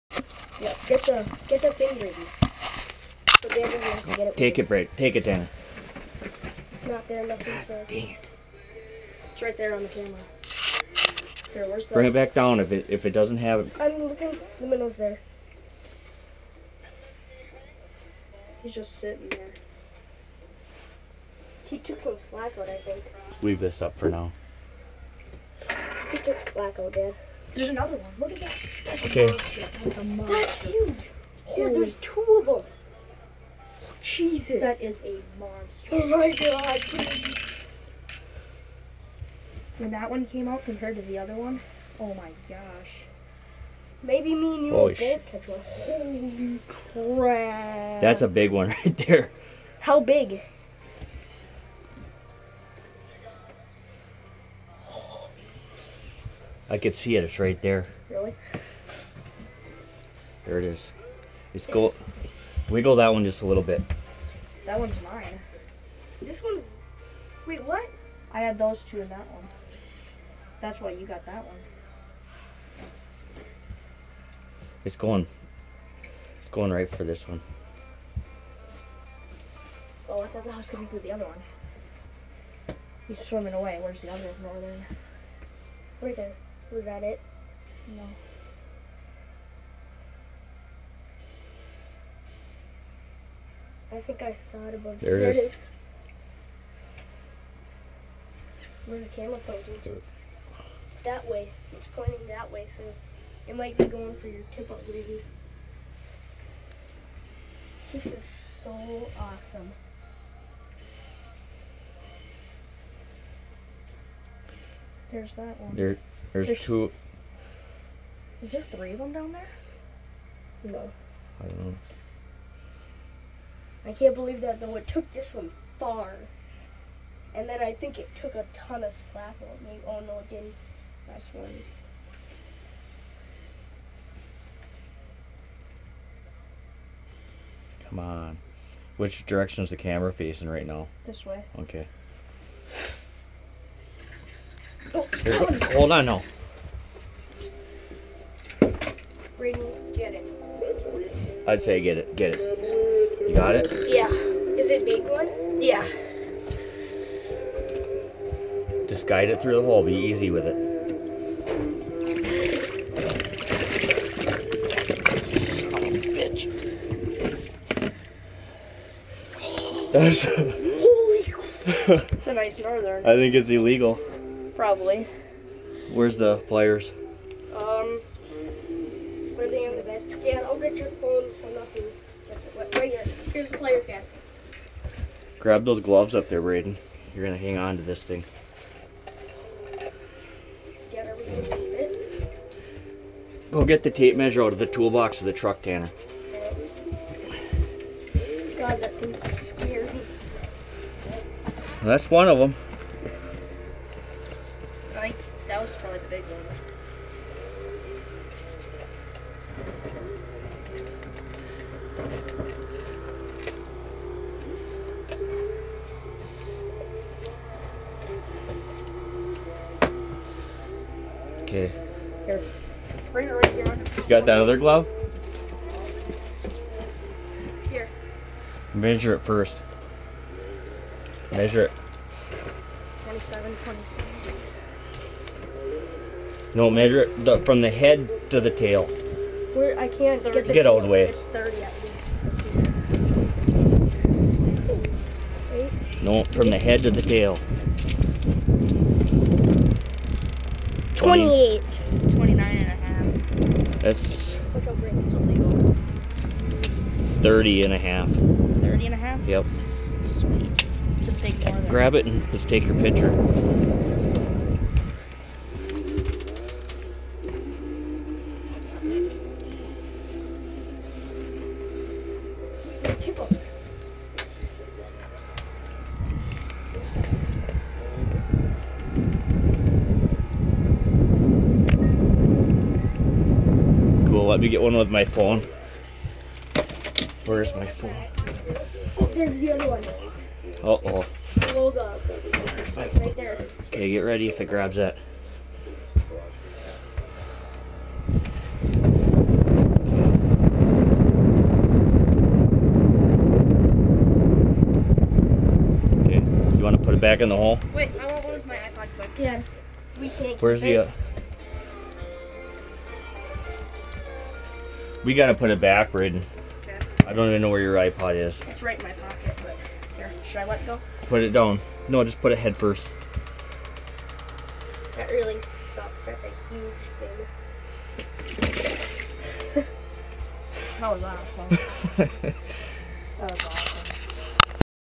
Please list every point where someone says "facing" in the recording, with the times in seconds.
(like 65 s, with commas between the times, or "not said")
140 s.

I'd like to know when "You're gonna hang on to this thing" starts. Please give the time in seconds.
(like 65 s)
187 s.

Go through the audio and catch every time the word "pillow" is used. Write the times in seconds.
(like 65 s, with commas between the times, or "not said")
not said.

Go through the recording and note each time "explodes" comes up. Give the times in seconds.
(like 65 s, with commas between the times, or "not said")
not said.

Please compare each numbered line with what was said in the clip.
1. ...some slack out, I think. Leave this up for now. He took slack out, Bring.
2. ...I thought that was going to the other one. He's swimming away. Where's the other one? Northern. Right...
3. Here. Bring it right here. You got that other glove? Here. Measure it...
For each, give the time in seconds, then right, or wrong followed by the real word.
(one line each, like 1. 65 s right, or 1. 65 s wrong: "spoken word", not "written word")
1. 22 s wrong: "Dad", not "Bring"
2. 80 s right
3. 222 s right.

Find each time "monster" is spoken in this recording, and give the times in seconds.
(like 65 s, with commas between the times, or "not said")
30 s, 35 s.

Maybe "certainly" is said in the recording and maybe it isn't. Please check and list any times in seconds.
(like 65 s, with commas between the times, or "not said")
not said.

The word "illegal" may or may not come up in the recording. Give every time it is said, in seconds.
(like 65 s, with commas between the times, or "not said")
173 s, 255 s.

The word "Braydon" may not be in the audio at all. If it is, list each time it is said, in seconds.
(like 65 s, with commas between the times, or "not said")
186 s, 315 s.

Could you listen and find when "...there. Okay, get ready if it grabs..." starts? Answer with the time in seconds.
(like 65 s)
293 s.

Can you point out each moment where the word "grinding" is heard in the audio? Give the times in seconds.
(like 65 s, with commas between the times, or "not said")
not said.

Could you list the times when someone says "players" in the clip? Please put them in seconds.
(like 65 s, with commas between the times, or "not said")
176 s, 183 s.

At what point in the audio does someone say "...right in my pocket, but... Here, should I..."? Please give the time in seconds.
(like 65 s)
318 s.